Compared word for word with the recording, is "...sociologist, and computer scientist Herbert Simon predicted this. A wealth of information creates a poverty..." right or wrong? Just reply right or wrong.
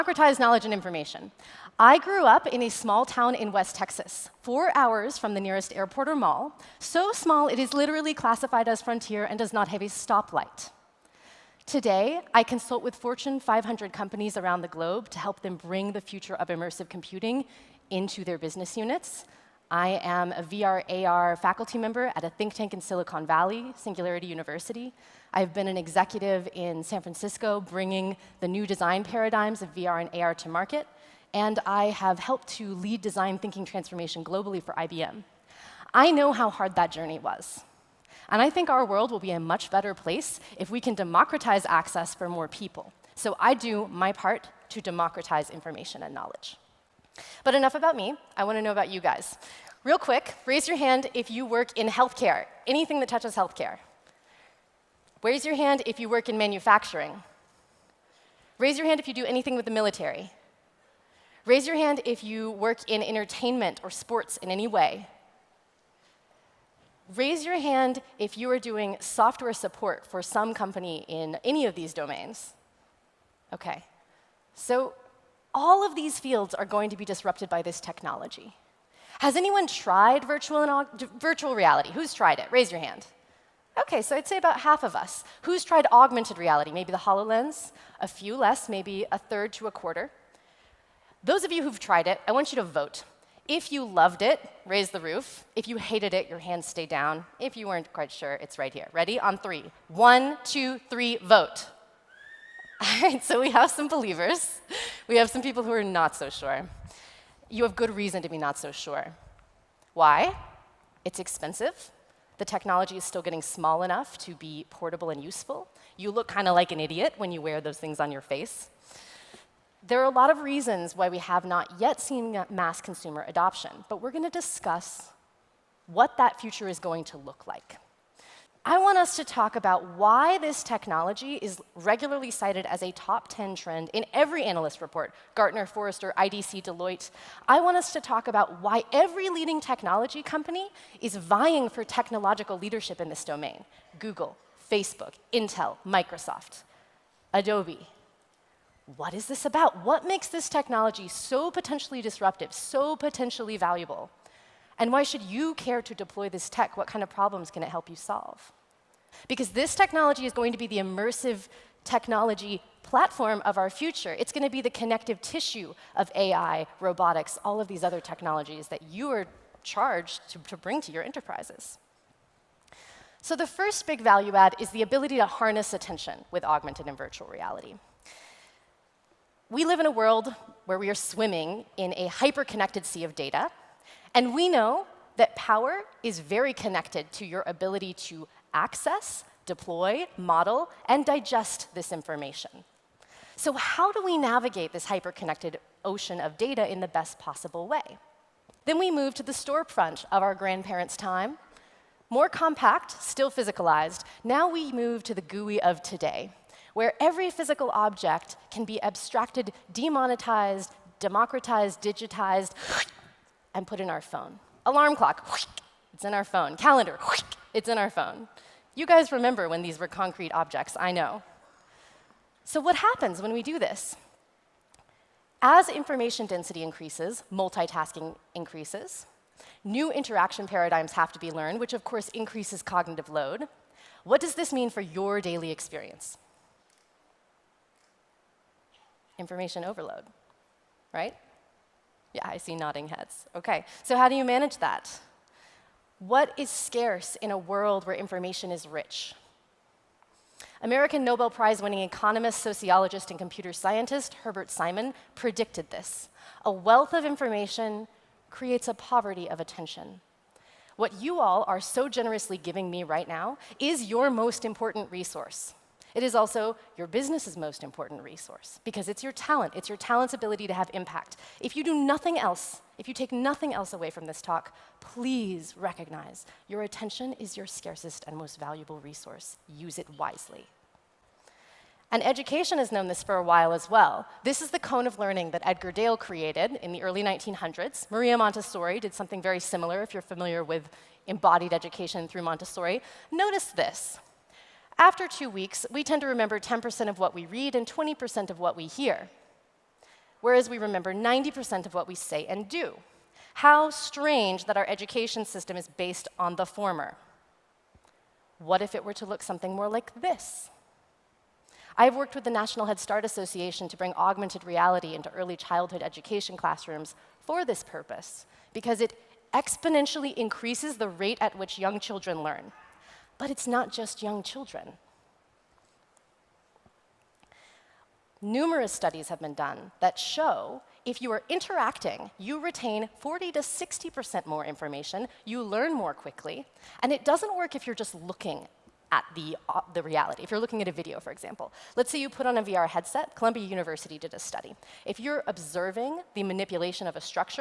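right.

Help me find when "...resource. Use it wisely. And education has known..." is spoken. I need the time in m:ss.
4:38.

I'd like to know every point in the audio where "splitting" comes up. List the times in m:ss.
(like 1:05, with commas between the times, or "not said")
not said.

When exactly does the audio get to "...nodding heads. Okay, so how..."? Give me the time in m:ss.
4:02.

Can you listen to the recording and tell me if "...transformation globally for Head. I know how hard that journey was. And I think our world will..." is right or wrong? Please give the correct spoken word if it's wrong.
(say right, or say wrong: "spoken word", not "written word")
wrong: "IBM", not "Head".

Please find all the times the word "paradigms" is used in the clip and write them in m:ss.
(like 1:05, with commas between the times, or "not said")
0:29, 3:50.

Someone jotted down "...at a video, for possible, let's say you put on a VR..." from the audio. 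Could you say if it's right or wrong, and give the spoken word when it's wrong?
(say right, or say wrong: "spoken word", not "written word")
wrong: "example", not "possible".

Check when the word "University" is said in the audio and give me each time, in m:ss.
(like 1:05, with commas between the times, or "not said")
0:24, 5:43.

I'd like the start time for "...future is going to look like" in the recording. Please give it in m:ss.
2:06.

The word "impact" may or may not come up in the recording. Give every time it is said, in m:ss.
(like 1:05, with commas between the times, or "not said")
4:30.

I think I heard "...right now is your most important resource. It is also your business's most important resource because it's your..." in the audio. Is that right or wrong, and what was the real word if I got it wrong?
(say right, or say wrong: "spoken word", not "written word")
right.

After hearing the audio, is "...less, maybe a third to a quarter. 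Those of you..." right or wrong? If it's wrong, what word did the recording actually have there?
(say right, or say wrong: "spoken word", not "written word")
right.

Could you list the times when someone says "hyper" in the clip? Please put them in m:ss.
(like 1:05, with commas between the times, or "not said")
3:02, 3:14.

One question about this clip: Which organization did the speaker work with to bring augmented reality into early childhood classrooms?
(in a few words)
National Head Start Association.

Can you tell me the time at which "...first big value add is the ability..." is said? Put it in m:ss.
2:53.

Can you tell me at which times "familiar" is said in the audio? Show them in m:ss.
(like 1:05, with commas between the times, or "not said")
4:50.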